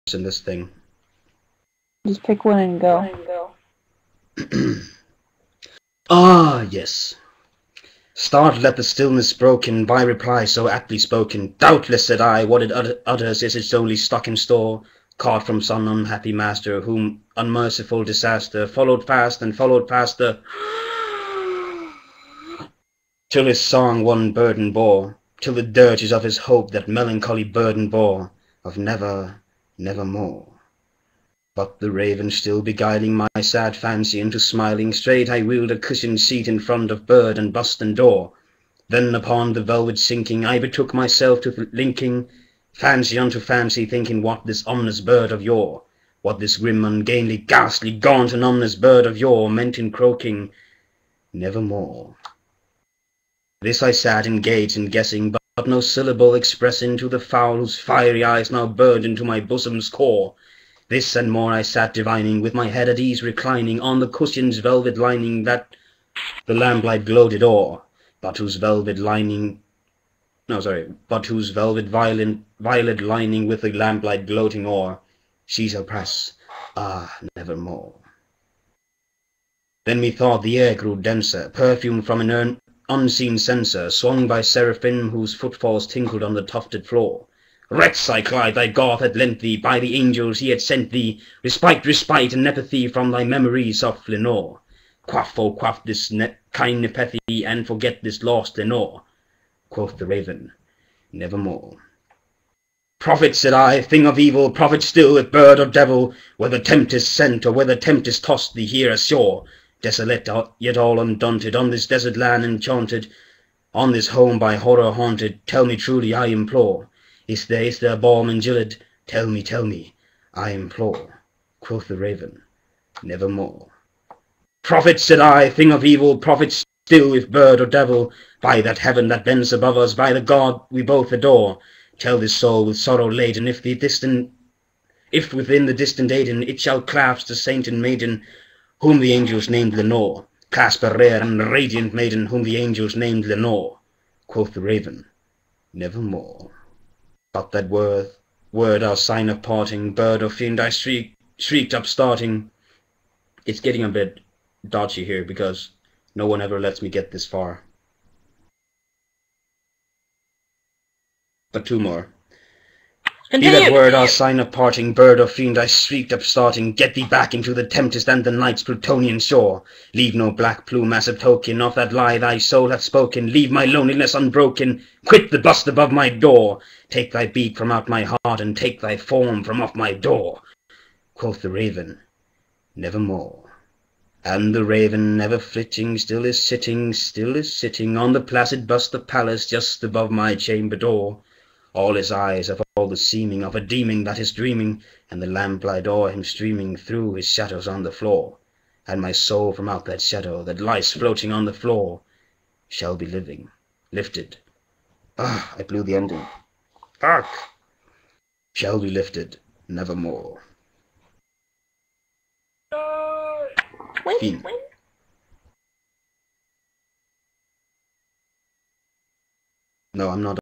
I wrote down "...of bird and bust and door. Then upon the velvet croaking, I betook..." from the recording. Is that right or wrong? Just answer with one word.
wrong.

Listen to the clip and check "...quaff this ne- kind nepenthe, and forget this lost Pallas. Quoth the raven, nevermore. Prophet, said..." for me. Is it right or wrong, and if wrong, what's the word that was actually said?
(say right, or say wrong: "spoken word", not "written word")
wrong: "Lenore", not "Pallas".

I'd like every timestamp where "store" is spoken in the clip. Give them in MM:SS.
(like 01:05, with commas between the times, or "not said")
00:14.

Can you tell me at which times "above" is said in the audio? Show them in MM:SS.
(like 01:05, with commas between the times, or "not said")
02:09, 02:55, 03:09.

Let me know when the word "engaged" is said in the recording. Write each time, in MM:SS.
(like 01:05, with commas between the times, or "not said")
00:54.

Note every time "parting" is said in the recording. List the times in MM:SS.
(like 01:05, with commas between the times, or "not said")
02:29, 02:44.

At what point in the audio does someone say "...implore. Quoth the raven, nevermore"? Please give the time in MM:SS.
02:00.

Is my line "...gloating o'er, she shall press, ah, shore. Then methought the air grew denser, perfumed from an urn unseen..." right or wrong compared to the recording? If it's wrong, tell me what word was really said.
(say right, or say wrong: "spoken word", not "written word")
wrong: "nevermore", not "shore".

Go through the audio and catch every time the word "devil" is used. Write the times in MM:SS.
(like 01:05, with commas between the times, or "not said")
01:45, 02:07.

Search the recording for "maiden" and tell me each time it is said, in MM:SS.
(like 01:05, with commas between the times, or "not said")
02:17, 02:21.